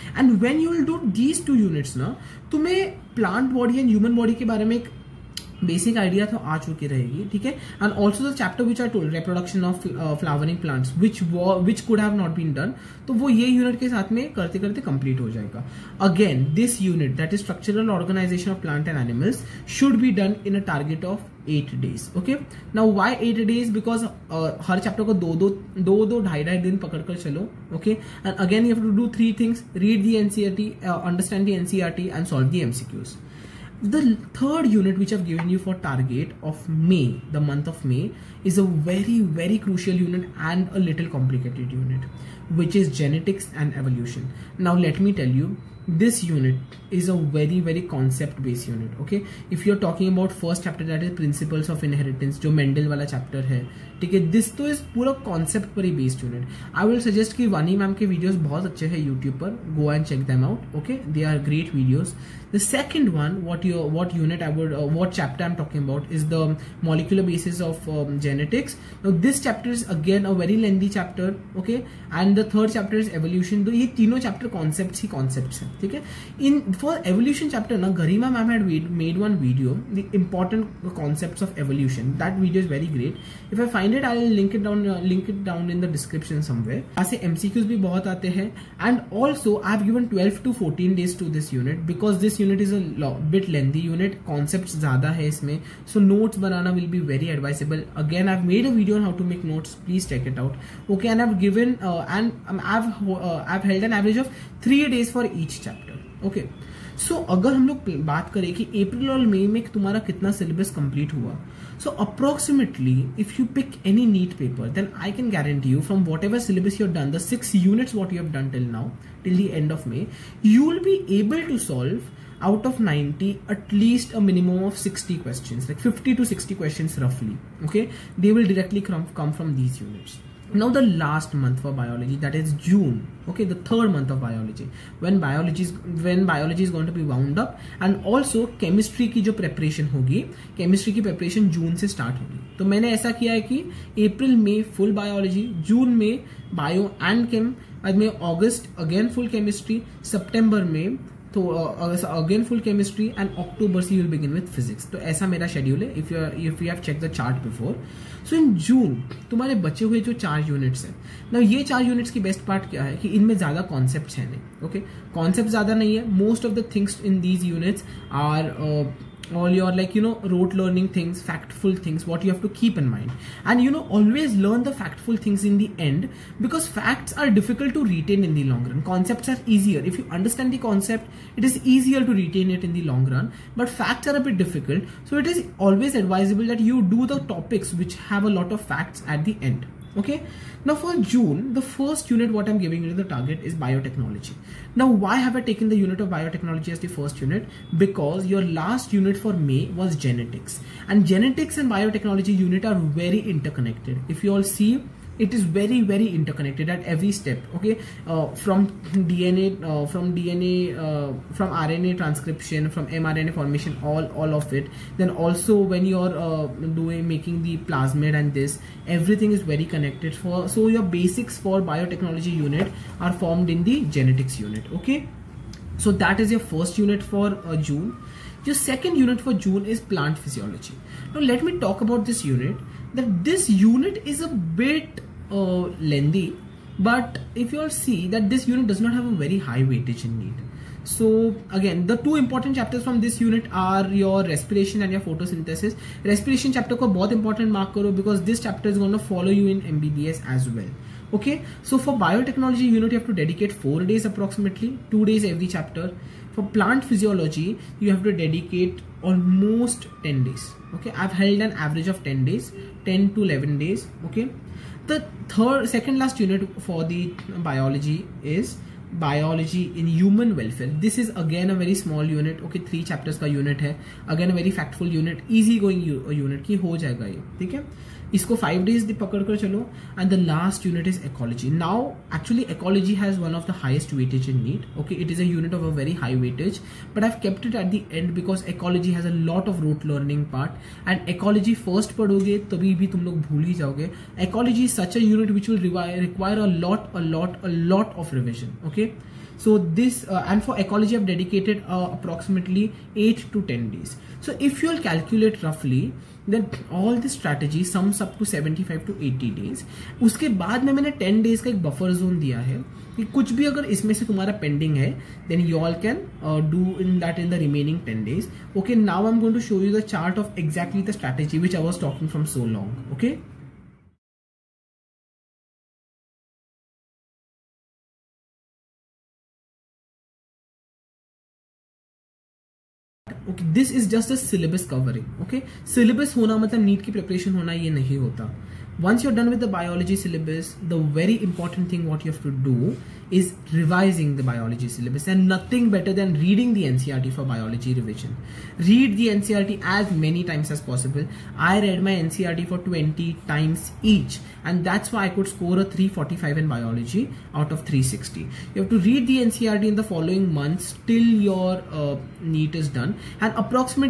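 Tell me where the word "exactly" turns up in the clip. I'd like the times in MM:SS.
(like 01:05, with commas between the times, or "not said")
05:20.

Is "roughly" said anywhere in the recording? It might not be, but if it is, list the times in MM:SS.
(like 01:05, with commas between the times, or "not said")
02:07, 05:05.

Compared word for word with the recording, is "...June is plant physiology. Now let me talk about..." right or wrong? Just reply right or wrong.
right.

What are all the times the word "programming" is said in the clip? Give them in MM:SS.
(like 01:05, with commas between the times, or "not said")
not said.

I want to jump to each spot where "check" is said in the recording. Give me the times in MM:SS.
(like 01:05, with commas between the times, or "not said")
01:00, 01:40.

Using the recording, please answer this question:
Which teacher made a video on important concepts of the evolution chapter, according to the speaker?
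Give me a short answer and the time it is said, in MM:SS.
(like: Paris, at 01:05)
Garima ma'am, at 01:17.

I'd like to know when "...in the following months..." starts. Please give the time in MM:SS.
05:59.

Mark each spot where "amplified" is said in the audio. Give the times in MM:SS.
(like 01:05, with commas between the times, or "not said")
not said.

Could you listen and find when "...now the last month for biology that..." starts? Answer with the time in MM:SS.
02:10.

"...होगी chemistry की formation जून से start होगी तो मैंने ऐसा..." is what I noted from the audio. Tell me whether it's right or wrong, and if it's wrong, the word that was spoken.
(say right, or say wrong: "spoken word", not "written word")
wrong: "preparation", not "formation".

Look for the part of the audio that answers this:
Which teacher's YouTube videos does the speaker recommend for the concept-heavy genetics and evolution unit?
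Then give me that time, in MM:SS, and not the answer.
00:57.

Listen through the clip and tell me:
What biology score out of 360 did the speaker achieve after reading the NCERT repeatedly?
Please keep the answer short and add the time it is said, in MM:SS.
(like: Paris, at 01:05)
345, at 05:55.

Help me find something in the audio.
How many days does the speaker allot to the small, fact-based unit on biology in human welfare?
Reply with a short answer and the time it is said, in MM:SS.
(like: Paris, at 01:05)
5 days, at 04:38.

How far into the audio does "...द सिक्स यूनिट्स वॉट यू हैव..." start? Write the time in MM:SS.
01:57.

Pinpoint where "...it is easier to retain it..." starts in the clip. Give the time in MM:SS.
03:01.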